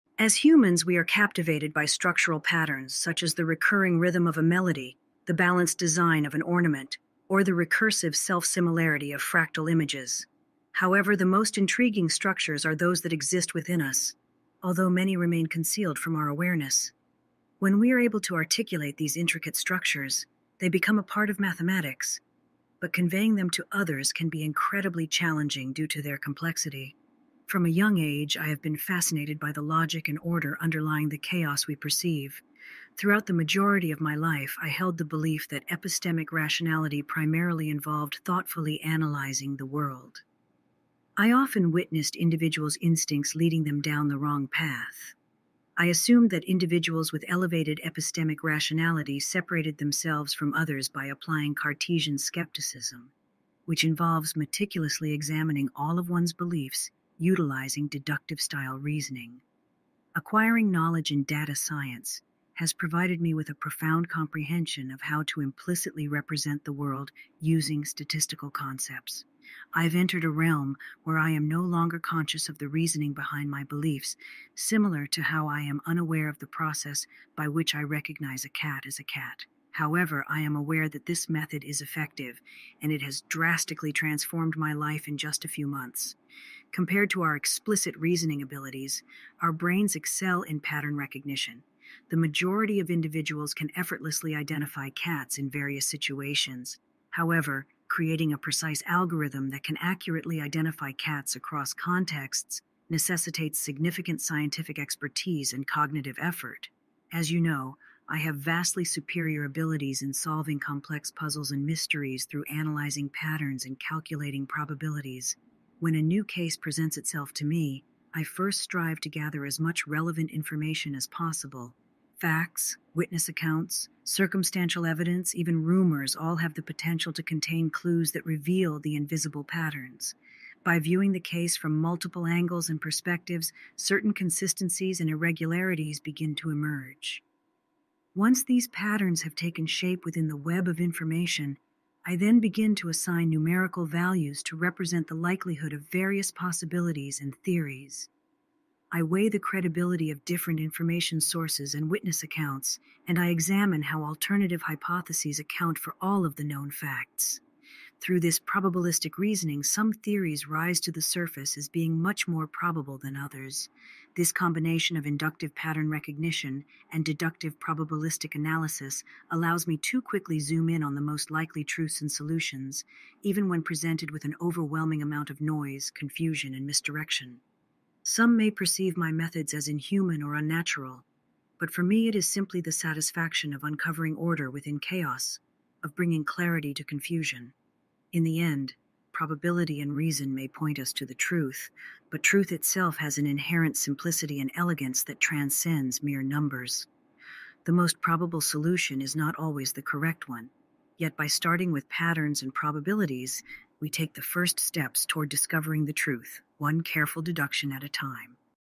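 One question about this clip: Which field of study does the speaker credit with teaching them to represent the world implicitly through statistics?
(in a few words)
data science.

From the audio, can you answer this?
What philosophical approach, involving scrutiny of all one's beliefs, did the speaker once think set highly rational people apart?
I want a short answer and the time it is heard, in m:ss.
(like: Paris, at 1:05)
Cartesian skepticism, at 0:51.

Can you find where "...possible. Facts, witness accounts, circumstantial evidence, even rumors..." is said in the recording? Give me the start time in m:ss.
2:01.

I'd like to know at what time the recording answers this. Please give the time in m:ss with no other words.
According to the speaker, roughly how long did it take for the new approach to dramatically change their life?
1:25.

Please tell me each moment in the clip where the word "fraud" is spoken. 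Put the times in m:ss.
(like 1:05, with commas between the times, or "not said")
not said.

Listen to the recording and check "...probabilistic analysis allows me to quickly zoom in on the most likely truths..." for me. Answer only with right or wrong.
right.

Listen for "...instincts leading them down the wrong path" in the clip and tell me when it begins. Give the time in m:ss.
0:42.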